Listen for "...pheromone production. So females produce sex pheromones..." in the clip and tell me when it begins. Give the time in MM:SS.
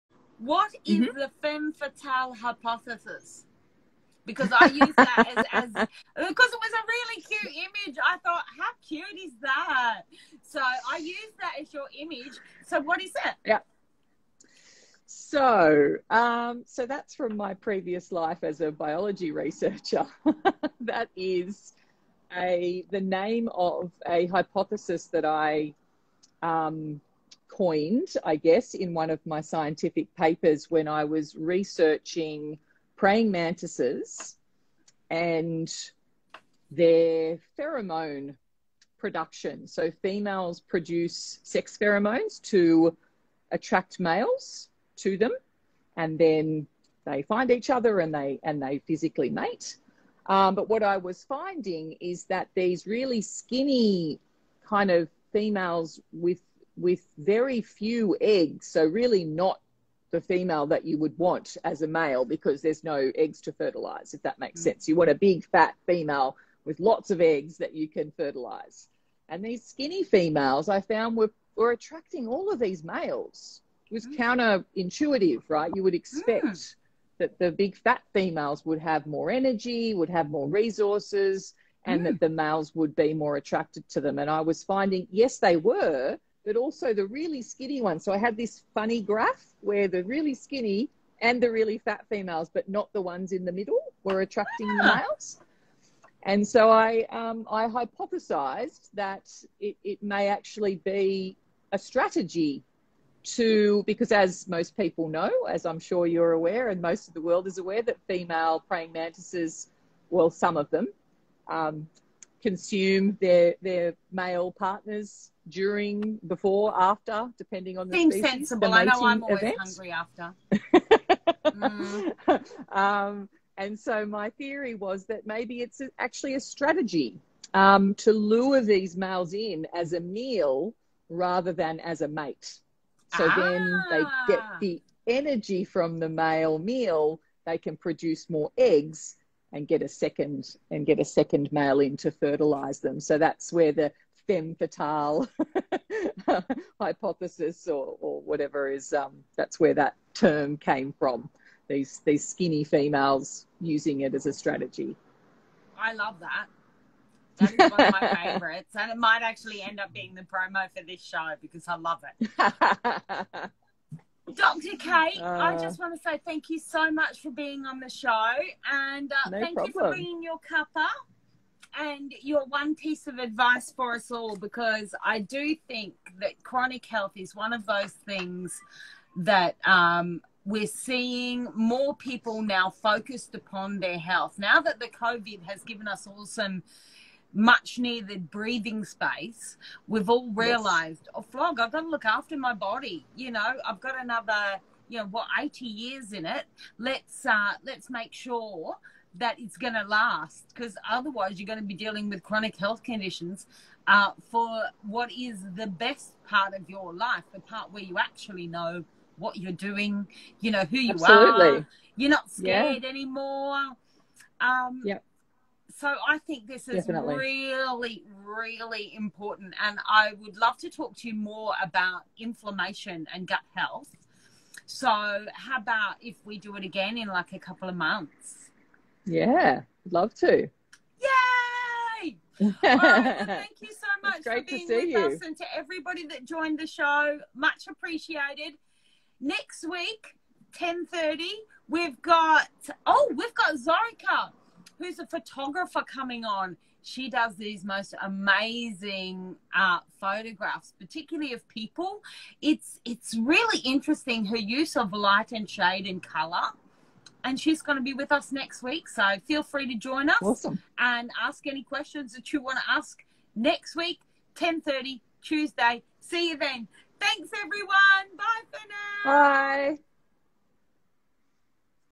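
00:37.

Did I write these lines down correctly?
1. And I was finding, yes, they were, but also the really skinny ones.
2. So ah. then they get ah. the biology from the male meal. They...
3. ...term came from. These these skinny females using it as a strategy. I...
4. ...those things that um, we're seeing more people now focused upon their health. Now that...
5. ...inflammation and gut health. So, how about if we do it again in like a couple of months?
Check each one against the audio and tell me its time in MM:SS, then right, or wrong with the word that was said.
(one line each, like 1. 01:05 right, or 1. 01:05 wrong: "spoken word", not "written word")
1. 01:24 right
2. 02:13 wrong: "energy", not "biology"
3. 02:30 right
4. 02:57 right
5. 03:42 right.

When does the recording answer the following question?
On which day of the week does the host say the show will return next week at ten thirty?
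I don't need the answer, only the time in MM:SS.
04:25.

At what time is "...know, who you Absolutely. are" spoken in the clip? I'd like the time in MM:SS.
03:30.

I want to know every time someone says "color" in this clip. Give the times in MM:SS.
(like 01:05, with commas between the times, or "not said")
04:16.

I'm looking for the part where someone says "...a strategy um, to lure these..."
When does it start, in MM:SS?
02:06.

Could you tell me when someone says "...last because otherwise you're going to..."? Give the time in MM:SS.
03:19.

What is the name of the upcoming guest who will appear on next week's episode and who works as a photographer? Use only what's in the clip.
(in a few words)
Zorica.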